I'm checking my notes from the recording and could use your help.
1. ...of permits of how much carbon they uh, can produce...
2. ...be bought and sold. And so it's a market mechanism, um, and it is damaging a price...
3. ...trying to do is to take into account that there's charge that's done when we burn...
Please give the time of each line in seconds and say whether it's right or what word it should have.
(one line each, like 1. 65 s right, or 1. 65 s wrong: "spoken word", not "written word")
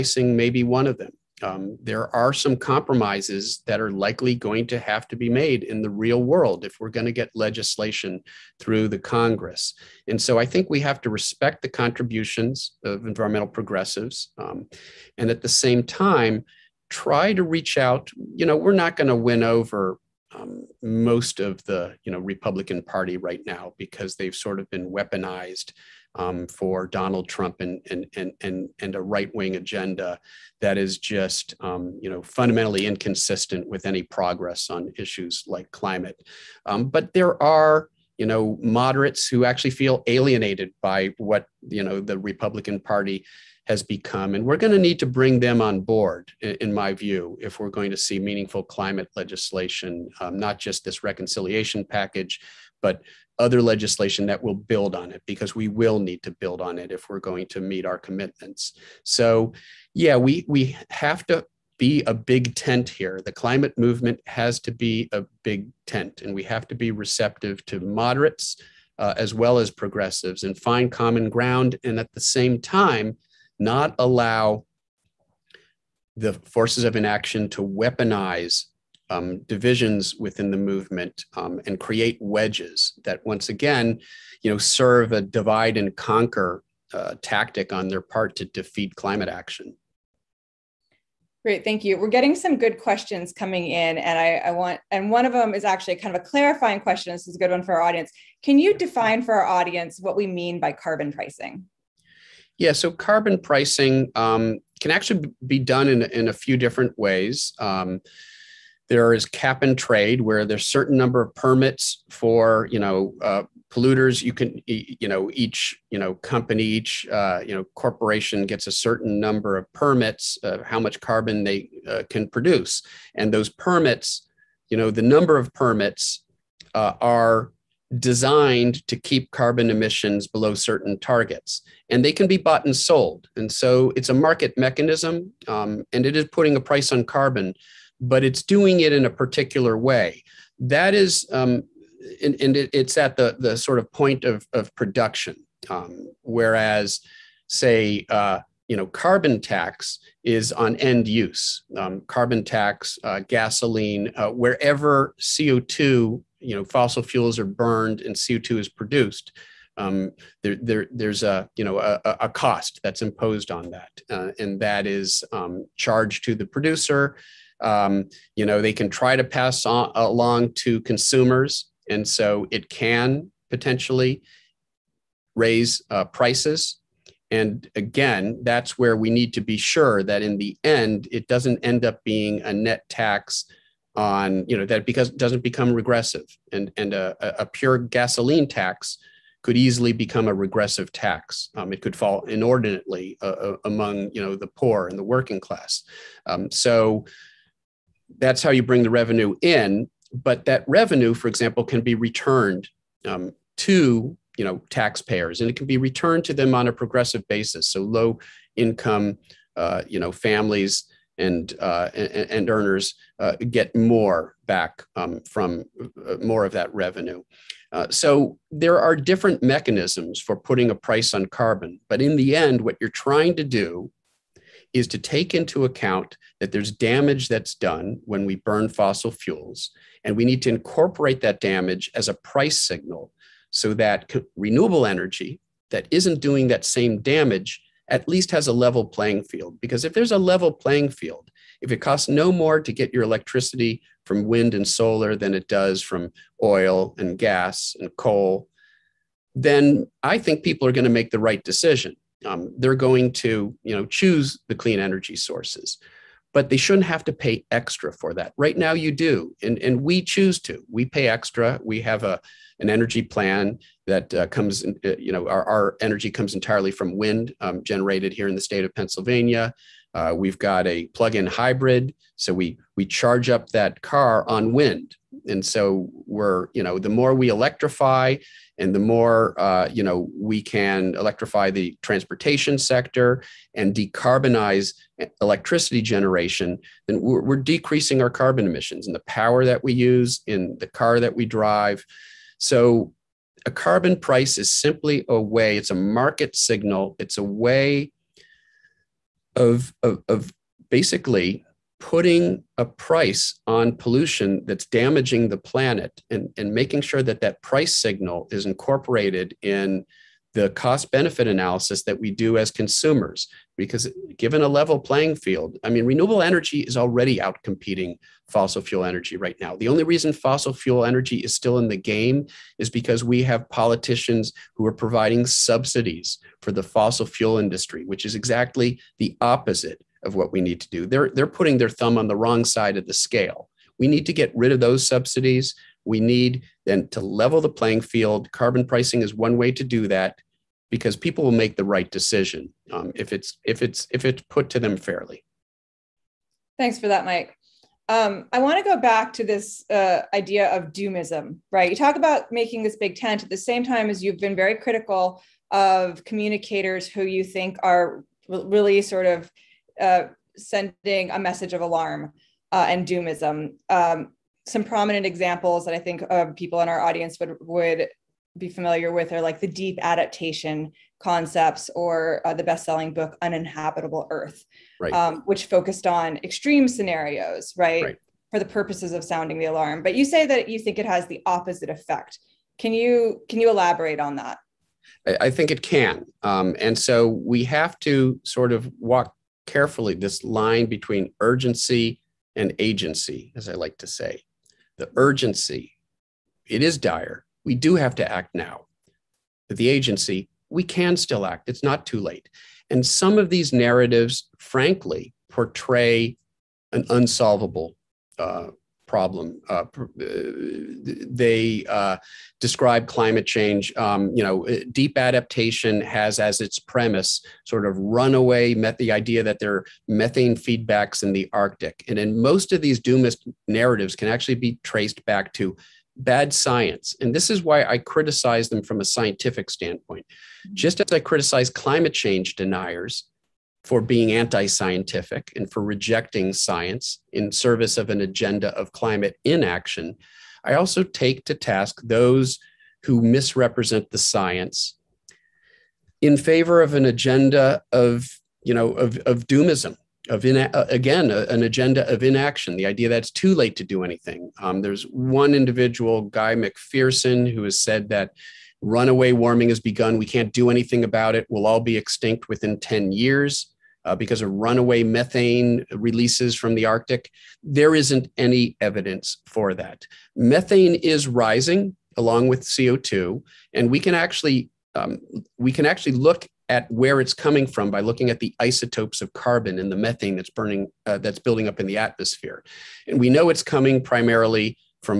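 1. 119 s right
2. 132 s wrong: "putting", not "damaging"
3. 223 s wrong: "damage", not "charge".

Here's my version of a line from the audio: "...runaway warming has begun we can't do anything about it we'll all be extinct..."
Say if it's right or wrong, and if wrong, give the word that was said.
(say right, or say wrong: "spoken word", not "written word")
right.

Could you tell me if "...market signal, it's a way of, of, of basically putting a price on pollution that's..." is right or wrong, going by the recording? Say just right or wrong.
right.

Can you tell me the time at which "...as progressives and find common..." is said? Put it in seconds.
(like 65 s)
69 s.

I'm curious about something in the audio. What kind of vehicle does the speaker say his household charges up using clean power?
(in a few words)
Plug-in hybrid.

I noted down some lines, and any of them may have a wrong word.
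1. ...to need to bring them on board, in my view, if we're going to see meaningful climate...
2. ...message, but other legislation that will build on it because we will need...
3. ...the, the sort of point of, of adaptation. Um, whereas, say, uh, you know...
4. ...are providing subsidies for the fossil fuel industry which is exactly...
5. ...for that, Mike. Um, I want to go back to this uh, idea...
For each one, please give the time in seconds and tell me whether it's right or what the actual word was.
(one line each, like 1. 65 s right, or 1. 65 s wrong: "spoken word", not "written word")
1. 44 s right
2. 51 s wrong: "package", not "message"
3. 143 s wrong: "production", not "adaptation"
4. 324 s right
5. 346 s right.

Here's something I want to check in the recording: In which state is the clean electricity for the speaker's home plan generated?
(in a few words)
Pennsylvania.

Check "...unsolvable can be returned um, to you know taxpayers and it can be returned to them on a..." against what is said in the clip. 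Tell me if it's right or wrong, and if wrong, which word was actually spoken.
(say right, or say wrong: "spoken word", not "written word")
wrong: "example", not "unsolvable".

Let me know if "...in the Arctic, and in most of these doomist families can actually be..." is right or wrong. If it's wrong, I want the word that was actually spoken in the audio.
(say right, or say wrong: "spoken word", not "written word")
wrong: "narratives", not "families".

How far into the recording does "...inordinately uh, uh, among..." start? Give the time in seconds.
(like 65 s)
192 s.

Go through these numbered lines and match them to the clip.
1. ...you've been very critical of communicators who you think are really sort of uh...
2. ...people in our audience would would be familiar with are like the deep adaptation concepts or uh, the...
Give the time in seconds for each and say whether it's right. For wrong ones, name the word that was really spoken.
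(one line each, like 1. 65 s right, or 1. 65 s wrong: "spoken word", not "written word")
1. 354 s right
2. 366 s right.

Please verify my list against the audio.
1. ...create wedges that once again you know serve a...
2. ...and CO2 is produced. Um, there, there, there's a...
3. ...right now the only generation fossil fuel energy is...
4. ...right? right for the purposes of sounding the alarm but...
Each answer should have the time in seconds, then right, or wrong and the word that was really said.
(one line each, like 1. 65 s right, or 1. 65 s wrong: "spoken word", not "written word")
1. 81 s right
2. 158 s right
3. 319 s wrong: "reason", not "generation"
4. 377 s right.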